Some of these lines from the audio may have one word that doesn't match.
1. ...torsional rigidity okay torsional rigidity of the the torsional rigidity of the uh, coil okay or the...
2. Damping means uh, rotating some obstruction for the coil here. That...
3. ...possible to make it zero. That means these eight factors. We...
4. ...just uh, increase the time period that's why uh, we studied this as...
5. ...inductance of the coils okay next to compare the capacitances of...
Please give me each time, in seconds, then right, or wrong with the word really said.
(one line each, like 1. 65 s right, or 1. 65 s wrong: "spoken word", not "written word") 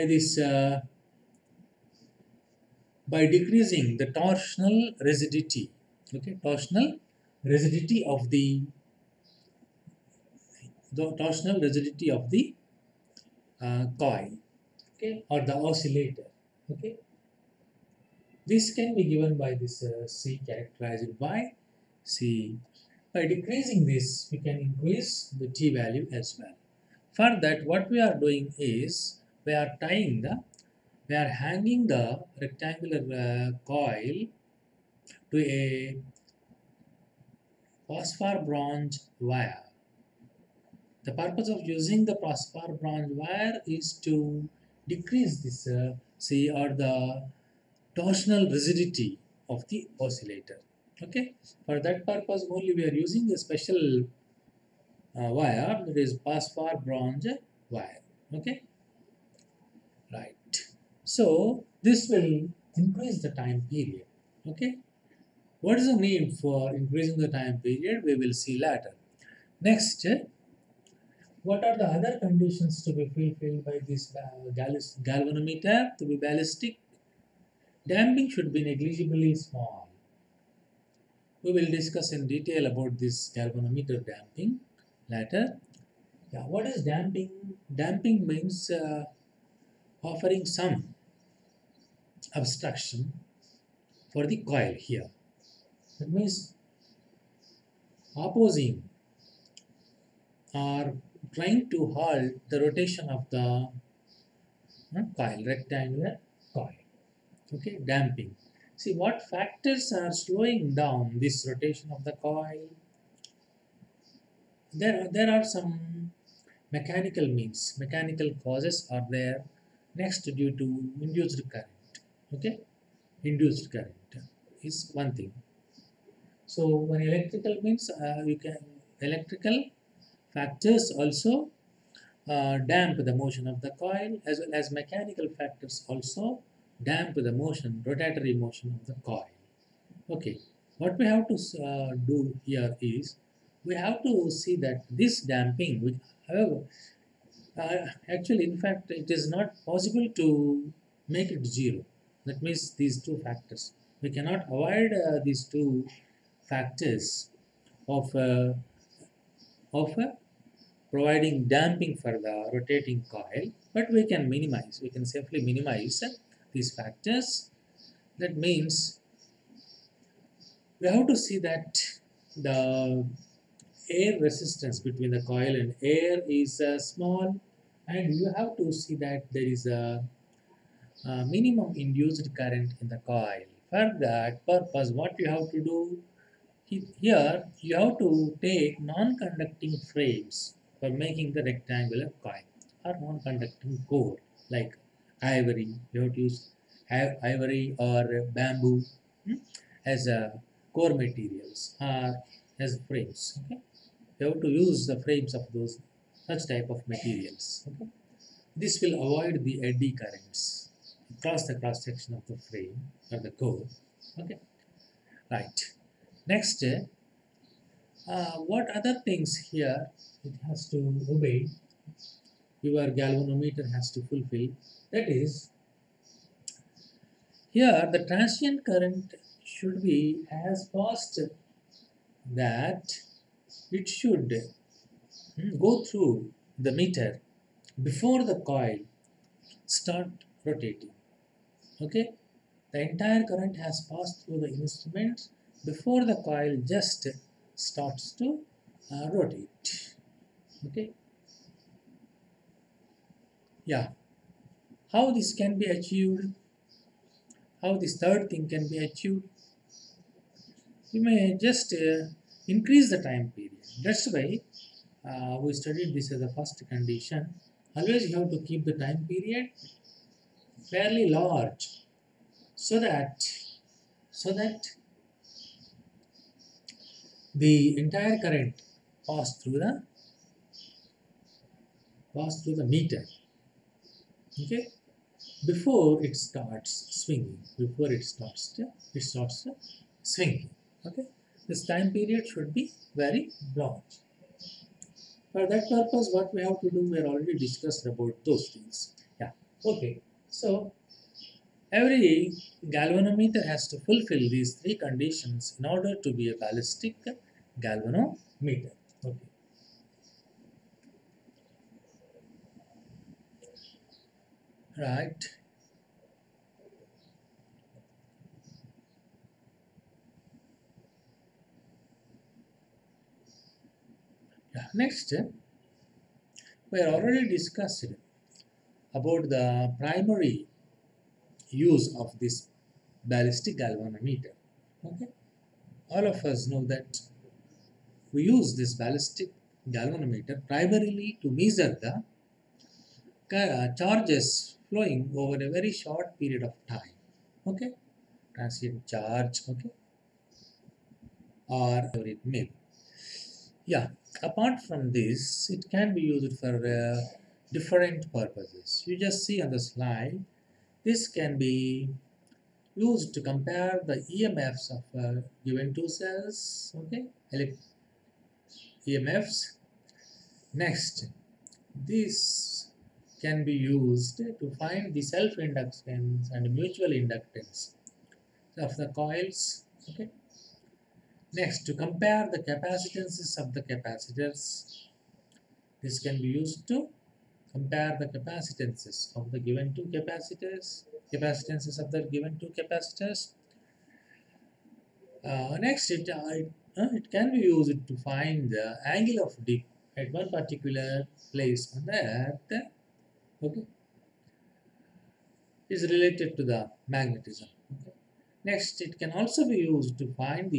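1. 4 s right
2. 87 s wrong: "offering", not "rotating"
3. 149 s wrong: "two", not "eight"
4. 261 s right
5. 376 s right.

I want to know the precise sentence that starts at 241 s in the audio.
Okay, the entire current has passed through the instrument before the coil just starts to uh, rotate.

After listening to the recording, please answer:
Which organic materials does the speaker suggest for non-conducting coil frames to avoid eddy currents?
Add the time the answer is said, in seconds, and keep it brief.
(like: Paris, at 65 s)
Ivory or bamboo, at 196 s.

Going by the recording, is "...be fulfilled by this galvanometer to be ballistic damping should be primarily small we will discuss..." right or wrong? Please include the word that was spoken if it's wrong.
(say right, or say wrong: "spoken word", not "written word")
wrong: "negligibly", not "primarily".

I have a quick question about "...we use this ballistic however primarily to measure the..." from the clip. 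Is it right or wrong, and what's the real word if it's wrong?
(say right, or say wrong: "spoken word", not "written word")
wrong: "galvanometer", not "however".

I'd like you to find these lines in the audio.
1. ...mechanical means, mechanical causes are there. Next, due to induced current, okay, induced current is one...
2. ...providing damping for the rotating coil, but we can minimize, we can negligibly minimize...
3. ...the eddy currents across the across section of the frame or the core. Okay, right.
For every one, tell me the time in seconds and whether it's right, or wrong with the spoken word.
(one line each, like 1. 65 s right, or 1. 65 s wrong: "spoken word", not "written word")
1. 116 s right
2. 160 s wrong: "safely", not "negligibly"
3. 209 s wrong: "cross", not "across".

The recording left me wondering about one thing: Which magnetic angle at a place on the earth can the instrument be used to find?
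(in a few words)
Angle of dip.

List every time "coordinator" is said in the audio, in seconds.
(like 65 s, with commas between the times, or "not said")
not said.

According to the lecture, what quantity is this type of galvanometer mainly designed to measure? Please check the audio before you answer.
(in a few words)
Transient charge.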